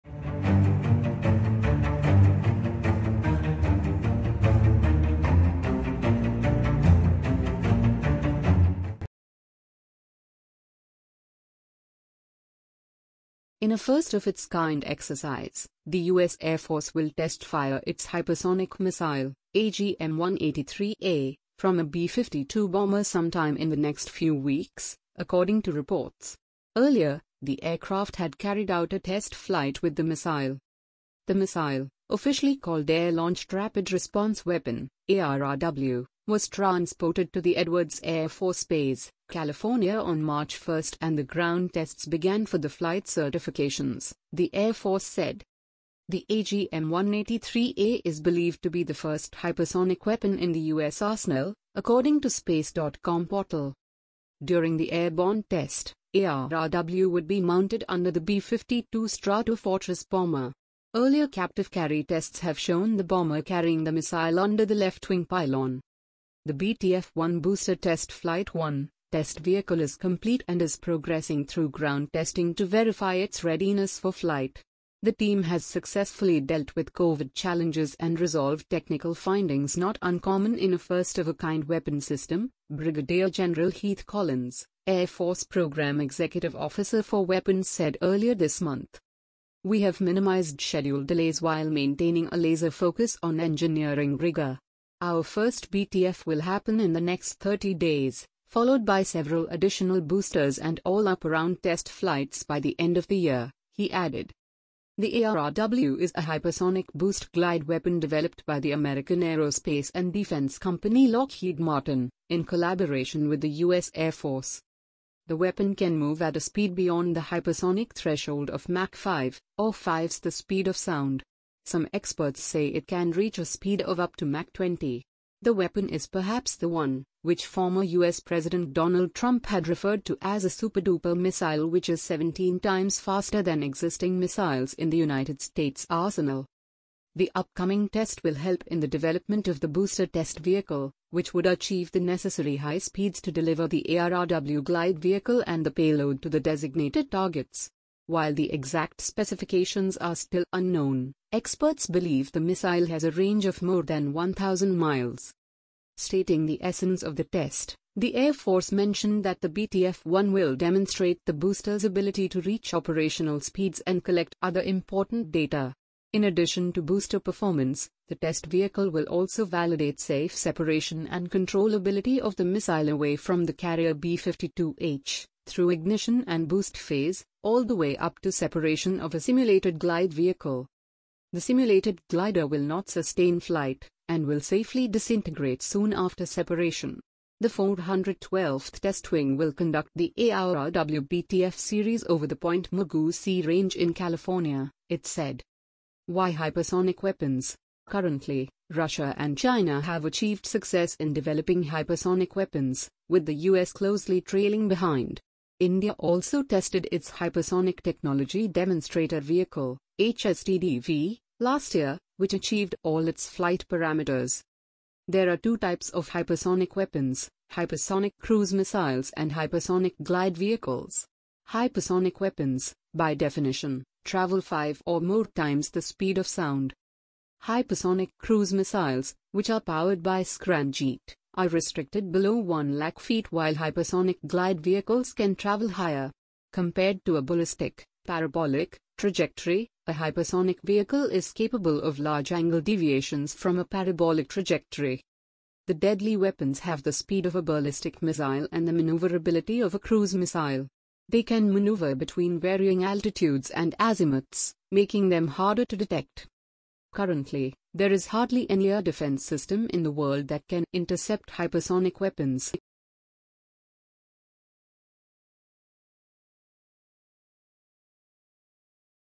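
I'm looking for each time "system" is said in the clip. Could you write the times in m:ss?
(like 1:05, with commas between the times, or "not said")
1:22, 4:19.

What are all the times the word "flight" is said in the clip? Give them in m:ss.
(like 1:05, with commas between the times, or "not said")
0:29, 0:42, 1:08, 1:14, 1:41, 3:03, 3:33.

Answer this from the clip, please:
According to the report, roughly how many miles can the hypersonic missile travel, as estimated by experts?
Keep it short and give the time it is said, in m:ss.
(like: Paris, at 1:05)
more than 1,000 miles, at 2:33.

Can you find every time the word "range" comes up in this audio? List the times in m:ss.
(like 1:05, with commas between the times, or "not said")
2:33, 3:13.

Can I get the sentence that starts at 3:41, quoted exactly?
Hypersonic weapons, by definition, travel five or more times the speed of sound.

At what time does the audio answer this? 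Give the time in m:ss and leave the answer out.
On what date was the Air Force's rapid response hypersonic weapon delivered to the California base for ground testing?
0:40.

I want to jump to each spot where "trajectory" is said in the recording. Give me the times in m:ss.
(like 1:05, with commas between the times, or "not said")
3:58, 4:04.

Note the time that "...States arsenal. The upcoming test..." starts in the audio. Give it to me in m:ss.
2:15.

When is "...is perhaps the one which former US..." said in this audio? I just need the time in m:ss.
2:05.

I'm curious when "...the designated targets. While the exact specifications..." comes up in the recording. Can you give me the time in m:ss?
2:26.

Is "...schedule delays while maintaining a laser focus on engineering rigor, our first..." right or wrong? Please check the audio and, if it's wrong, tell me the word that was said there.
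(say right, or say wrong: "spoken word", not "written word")
right.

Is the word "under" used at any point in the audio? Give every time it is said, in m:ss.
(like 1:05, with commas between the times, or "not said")
0:57, 1:04.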